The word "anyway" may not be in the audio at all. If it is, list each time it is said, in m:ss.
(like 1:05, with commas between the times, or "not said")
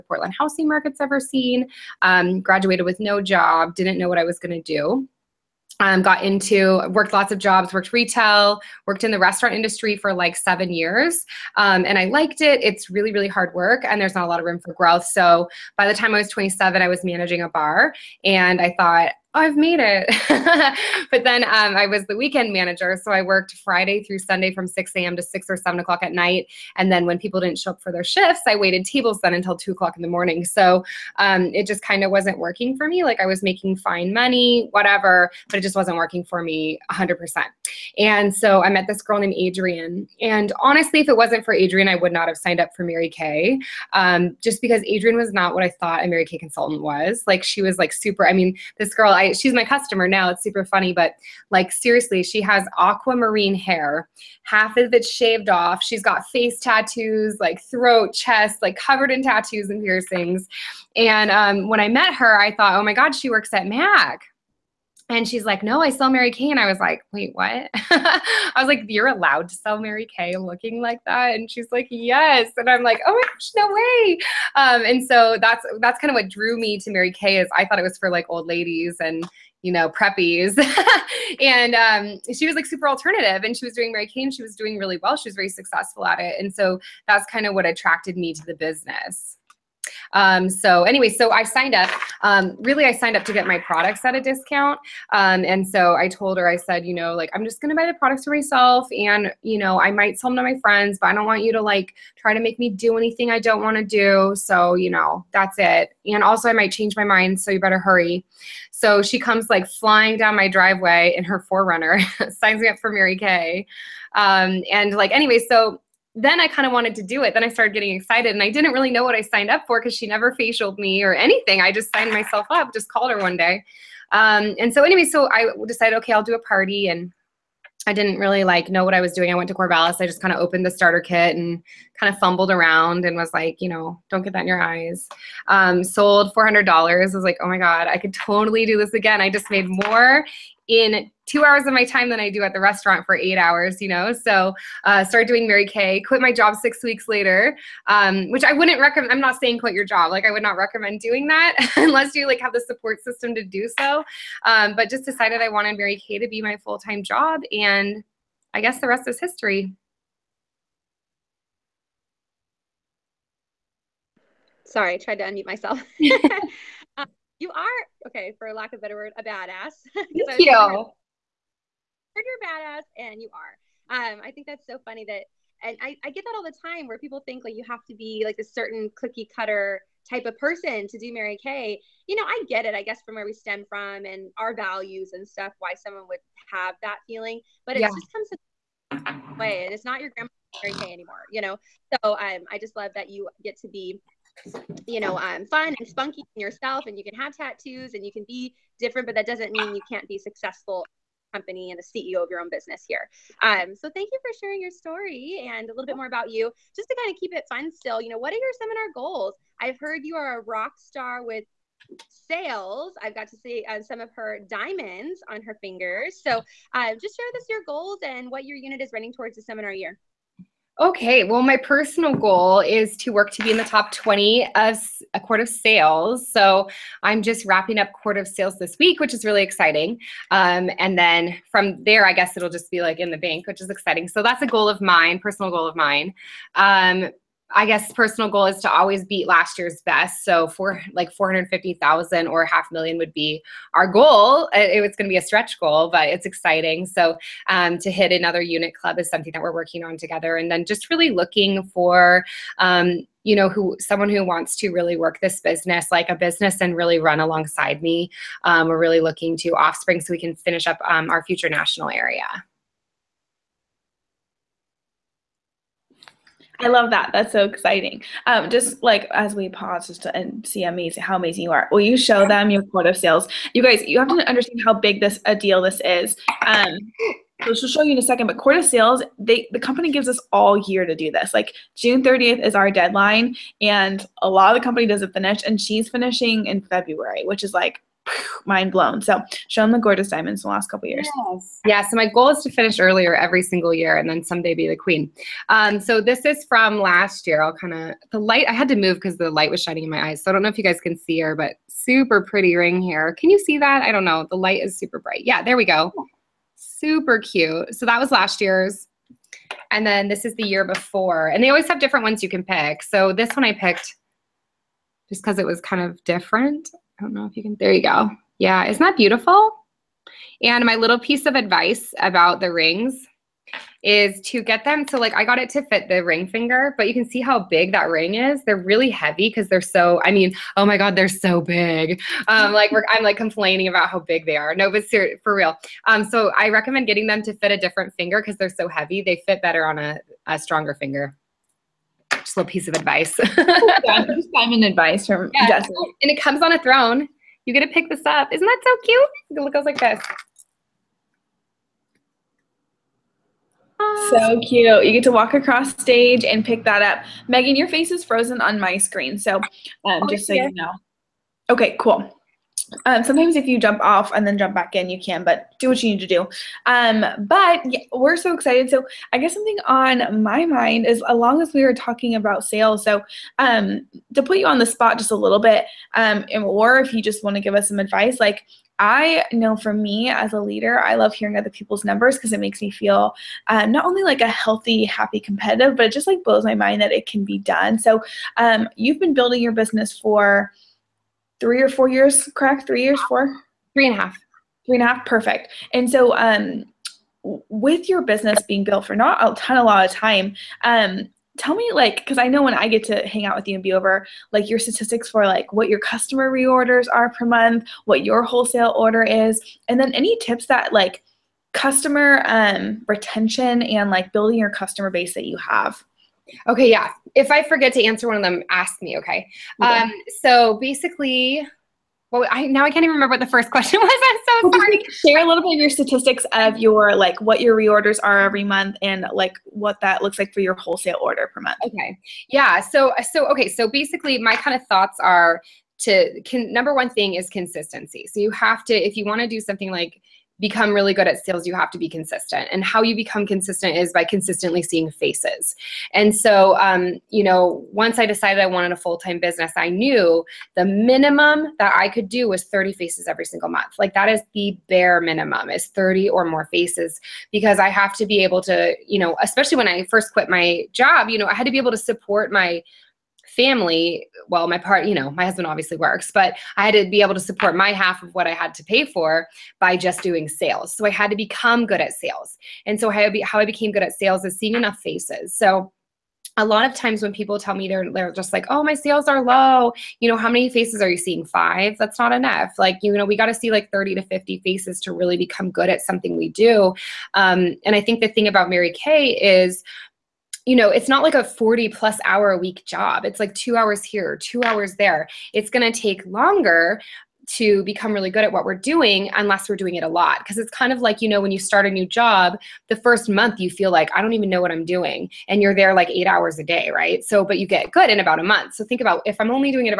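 1:30, 1:55, 2:04.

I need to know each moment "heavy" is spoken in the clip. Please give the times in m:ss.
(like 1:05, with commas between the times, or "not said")
5:28, 5:38.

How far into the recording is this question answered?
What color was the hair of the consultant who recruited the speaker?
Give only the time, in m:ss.
0:52.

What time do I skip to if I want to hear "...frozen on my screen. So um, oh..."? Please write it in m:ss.
5:58.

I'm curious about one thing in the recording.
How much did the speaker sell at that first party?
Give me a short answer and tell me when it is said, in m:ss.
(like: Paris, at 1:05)
$400, at 2:16.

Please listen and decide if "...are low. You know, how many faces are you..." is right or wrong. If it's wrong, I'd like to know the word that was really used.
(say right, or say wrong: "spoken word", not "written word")
right.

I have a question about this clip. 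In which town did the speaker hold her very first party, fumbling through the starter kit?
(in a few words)
Corvallis.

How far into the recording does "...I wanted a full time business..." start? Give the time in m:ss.
7:28.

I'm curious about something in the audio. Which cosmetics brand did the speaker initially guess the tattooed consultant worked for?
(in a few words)
Mac.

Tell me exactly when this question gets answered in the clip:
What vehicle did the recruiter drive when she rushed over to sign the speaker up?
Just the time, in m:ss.
1:51.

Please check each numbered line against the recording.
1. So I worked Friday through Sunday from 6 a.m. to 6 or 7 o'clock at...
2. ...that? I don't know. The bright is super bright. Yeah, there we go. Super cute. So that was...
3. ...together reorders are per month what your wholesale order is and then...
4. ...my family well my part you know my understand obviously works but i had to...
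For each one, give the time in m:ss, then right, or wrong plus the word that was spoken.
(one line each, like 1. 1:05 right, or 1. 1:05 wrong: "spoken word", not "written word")
1. 0:23 right
2. 5:03 wrong: "light", not "bright"
3. 6:45 wrong: "customer", not "together"
4. 7:42 wrong: "husband", not "understand".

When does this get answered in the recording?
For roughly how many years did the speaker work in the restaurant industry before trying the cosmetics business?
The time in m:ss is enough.
0:10.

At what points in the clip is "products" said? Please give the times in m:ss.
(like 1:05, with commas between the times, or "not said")
1:33, 1:37.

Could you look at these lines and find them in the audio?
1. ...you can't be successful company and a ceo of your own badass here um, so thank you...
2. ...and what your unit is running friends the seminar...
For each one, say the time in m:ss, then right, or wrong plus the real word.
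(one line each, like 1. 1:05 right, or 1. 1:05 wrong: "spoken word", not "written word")
1. 3:19 wrong: "business", not "badass"
2. 3:38 wrong: "towards", not "friends".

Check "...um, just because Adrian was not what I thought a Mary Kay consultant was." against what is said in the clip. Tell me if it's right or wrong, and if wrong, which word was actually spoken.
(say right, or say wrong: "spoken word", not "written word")
right.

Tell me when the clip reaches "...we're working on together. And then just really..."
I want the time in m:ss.
4:09.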